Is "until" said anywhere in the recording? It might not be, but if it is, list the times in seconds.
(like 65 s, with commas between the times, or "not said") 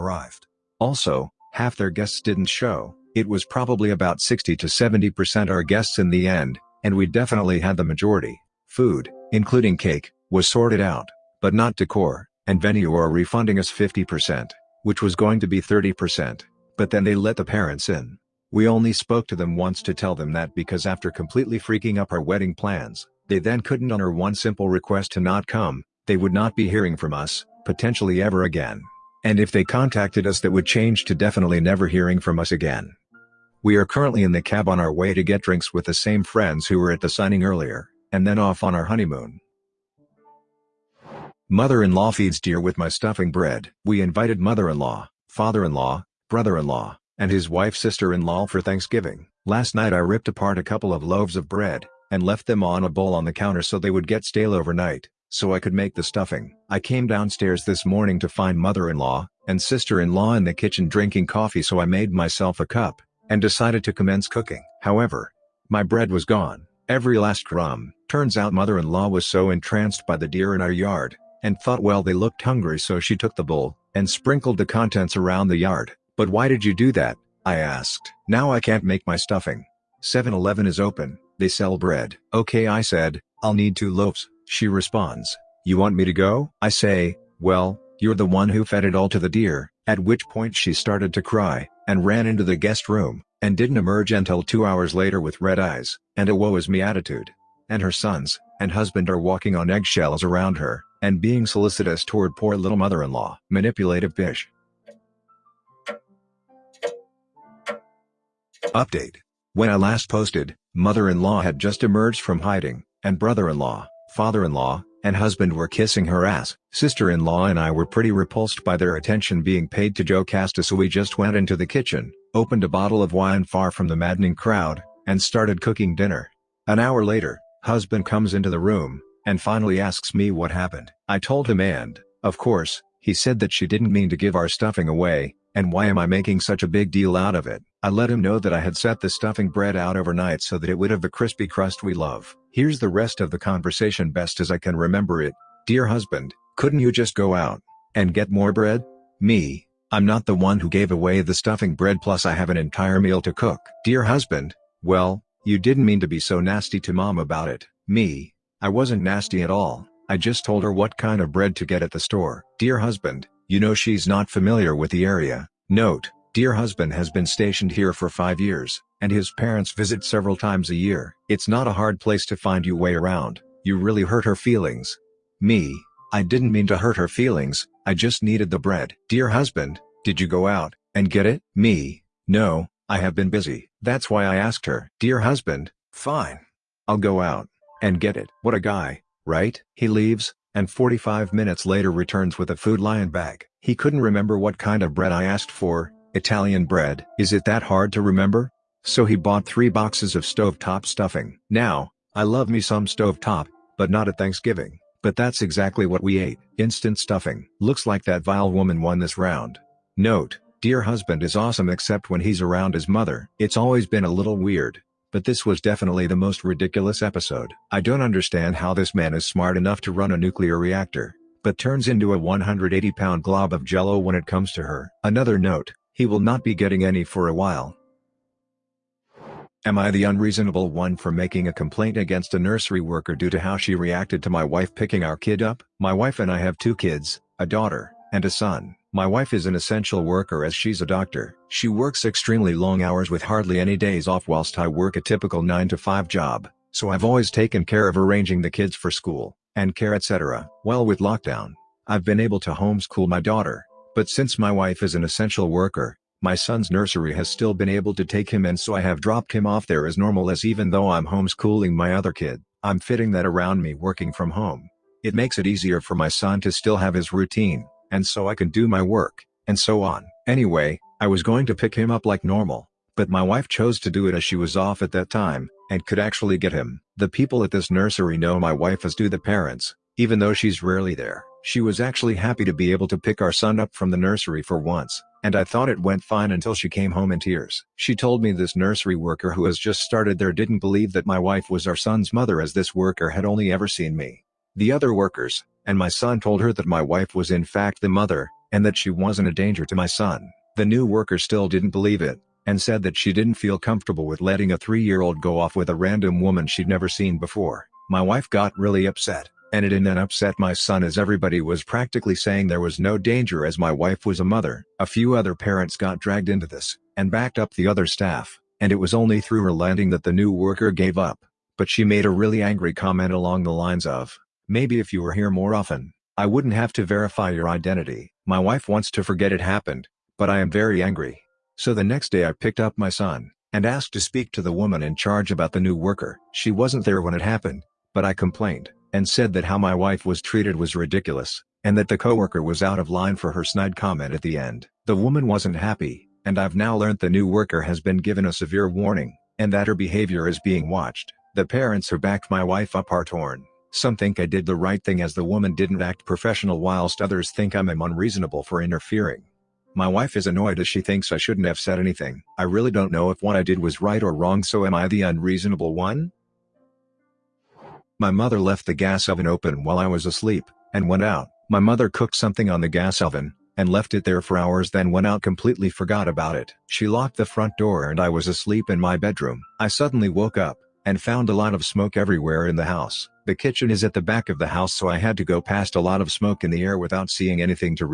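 94 s, 286 s.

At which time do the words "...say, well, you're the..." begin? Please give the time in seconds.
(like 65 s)
86 s.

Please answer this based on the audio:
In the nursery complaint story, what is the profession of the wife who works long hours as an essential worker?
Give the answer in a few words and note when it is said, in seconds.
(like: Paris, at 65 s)
doctor, at 240 s.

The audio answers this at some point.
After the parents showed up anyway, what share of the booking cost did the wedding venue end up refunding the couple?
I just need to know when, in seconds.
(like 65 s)
13 s.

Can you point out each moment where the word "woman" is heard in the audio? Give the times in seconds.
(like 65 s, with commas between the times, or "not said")
208 s, 306 s, 334 s, 344 s, 355 s.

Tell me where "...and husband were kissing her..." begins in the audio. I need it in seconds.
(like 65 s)
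115 s.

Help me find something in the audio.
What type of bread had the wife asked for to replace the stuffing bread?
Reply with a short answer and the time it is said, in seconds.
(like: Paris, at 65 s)
Italian bread, at 196 s.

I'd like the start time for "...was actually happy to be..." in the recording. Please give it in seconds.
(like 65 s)
281 s.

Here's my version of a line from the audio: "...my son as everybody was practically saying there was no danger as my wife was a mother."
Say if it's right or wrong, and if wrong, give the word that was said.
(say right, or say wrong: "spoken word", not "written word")
right.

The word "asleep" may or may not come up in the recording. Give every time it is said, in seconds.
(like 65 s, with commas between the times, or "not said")
370 s, 378 s.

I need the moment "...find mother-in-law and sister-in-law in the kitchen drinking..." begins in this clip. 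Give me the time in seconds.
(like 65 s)
58 s.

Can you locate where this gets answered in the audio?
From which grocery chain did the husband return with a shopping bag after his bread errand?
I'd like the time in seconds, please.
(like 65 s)
192 s.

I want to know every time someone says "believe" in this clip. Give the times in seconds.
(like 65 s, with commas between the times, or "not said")
290 s, 301 s.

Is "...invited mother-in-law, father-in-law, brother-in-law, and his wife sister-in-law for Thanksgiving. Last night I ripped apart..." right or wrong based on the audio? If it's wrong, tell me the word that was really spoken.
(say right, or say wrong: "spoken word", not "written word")
right.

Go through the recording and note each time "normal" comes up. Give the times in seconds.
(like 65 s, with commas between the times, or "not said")
259 s, 272 s.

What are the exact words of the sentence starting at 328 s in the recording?
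My wife wants to forget it happened, but I am very angry.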